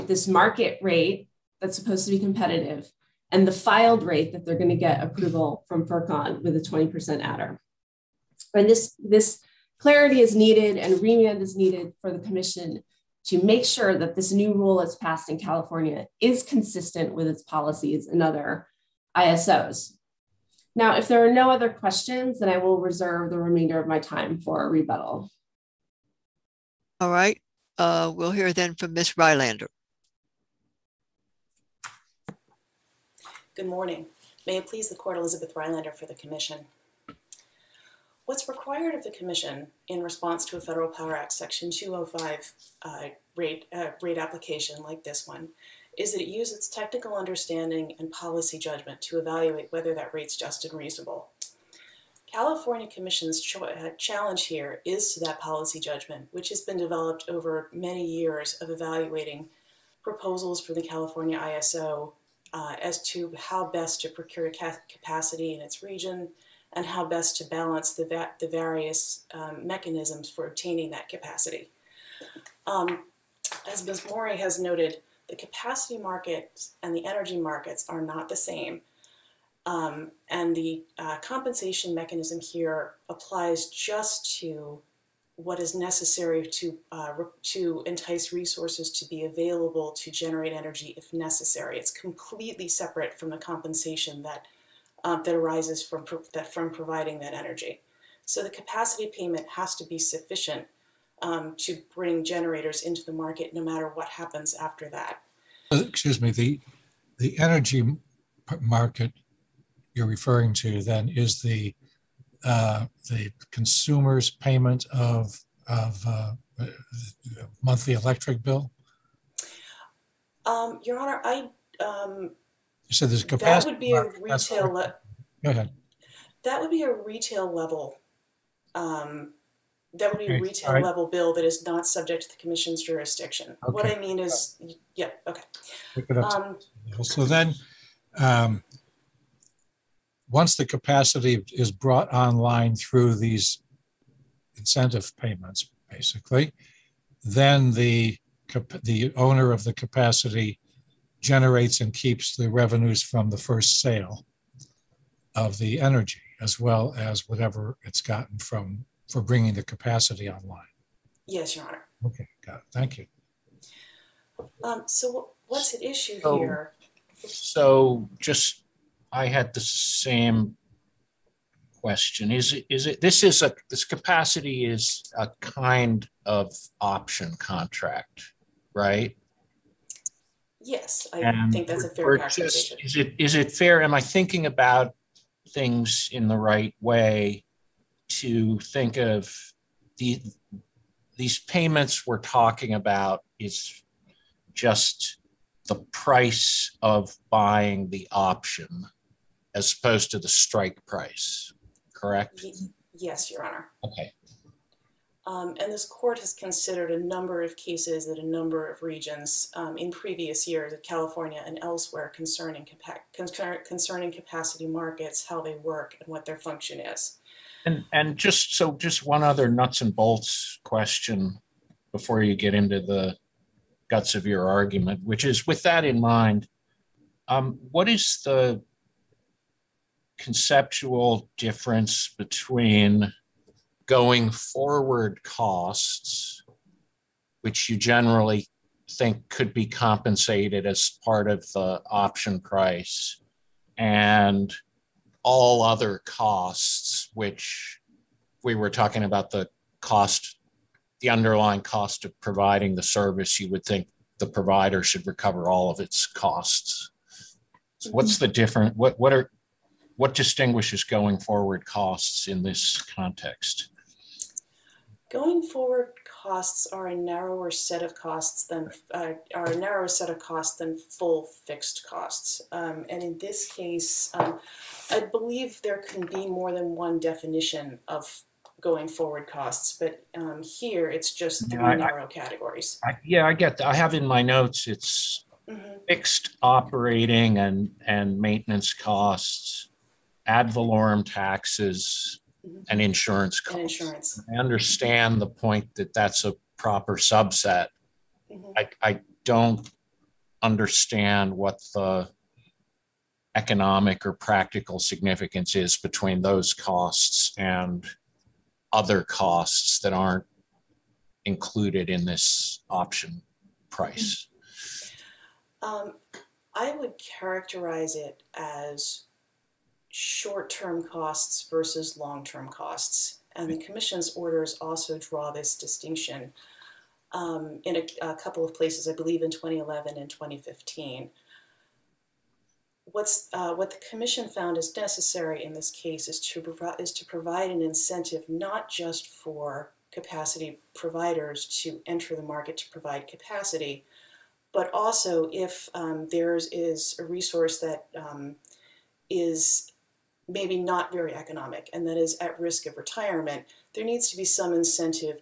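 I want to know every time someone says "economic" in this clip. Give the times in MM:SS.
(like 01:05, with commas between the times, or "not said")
05:03, 05:51.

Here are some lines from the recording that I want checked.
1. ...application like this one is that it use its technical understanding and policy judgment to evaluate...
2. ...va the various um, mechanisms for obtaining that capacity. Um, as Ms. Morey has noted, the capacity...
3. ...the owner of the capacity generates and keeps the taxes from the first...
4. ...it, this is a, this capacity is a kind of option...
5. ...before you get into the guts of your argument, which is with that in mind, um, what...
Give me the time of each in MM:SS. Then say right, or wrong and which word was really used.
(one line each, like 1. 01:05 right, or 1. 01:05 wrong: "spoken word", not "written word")
1. 00:44 right
2. 01:08 right
3. 02:28 wrong: "revenues", not "taxes"
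4. 02:52 right
5. 03:41 right.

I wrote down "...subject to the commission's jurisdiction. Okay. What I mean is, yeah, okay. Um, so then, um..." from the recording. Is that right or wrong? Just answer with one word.
right.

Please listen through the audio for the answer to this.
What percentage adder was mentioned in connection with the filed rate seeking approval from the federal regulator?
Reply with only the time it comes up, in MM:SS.
00:06.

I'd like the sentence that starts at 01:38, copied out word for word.
So the capacity payment has to be sufficient um, to bring generators into the market no matter what happens after that.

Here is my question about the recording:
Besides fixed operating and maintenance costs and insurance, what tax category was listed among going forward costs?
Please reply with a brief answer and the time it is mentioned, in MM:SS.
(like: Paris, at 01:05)
ad valorem taxes, at 04:50.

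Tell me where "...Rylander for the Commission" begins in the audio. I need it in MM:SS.
00:35.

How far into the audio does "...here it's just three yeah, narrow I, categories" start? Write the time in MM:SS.
04:40.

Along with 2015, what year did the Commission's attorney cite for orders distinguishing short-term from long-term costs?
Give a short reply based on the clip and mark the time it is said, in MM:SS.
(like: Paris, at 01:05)
2011, at 05:29.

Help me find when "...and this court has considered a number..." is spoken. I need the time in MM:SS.
03:25.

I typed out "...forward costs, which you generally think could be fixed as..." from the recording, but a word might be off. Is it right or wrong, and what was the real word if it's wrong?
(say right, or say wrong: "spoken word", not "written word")
wrong: "compensated", not "fixed".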